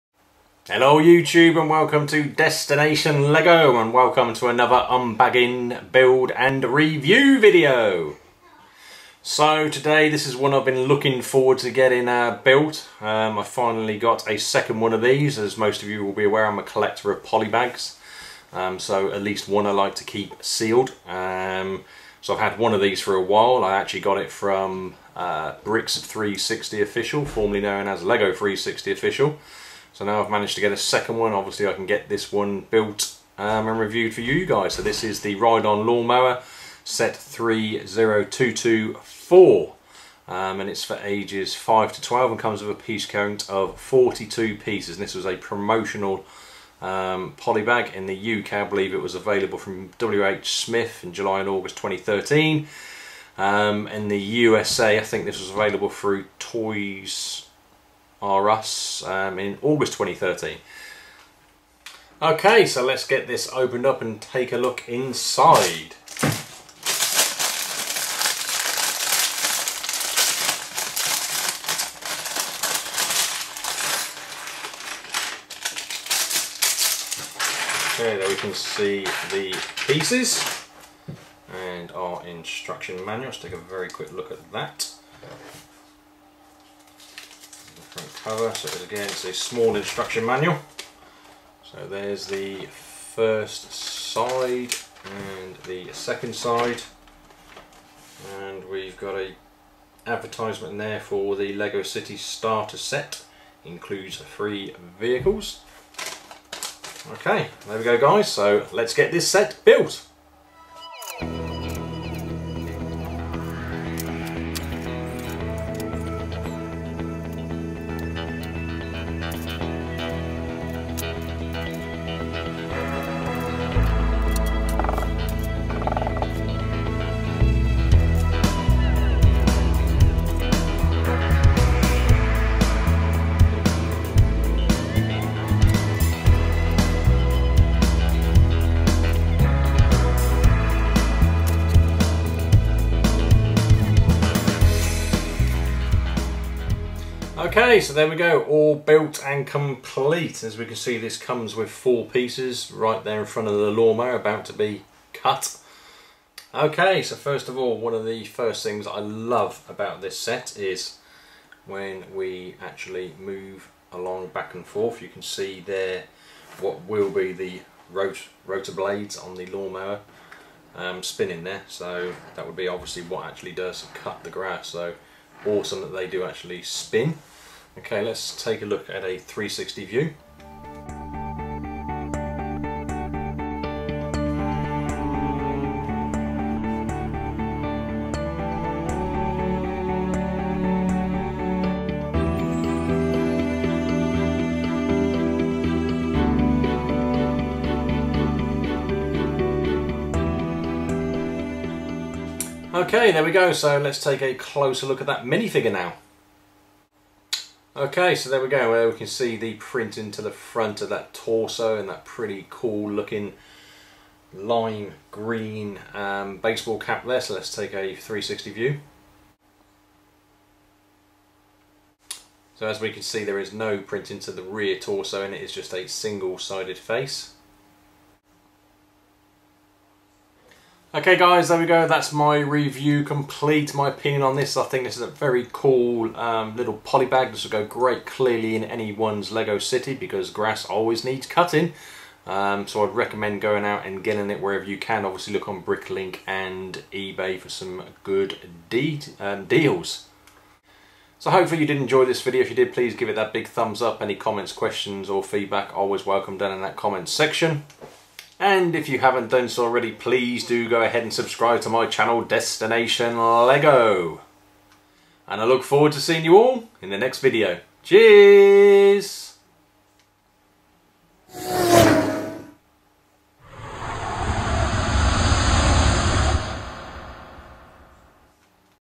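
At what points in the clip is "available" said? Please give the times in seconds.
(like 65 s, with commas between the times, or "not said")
49 s, 55 s.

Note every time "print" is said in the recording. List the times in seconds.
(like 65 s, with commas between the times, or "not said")
209 s, 223 s.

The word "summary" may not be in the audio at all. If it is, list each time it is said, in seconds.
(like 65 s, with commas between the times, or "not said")
not said.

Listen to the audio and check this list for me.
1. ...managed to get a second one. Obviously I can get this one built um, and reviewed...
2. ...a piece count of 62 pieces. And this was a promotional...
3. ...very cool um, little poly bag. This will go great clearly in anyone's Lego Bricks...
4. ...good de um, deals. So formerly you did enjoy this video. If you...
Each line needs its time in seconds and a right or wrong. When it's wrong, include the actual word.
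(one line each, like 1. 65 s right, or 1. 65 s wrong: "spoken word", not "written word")
1. 30 s right
2. 42 s wrong: "42", not "62"
3. 235 s wrong: "City", not "Bricks"
4. 248 s wrong: "hopefully", not "formerly".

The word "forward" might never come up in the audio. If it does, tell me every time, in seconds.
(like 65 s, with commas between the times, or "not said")
11 s, 265 s.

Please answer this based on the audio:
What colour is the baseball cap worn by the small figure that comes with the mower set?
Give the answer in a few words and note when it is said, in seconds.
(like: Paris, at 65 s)
Lime green, at 214 s.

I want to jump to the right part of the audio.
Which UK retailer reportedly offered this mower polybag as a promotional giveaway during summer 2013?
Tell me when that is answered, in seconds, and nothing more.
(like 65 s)
49 s.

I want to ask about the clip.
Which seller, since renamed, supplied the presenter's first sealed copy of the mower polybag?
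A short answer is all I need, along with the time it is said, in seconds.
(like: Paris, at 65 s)
Bricks 360 Official, at 25 s.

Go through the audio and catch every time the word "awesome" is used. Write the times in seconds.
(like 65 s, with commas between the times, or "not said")
175 s.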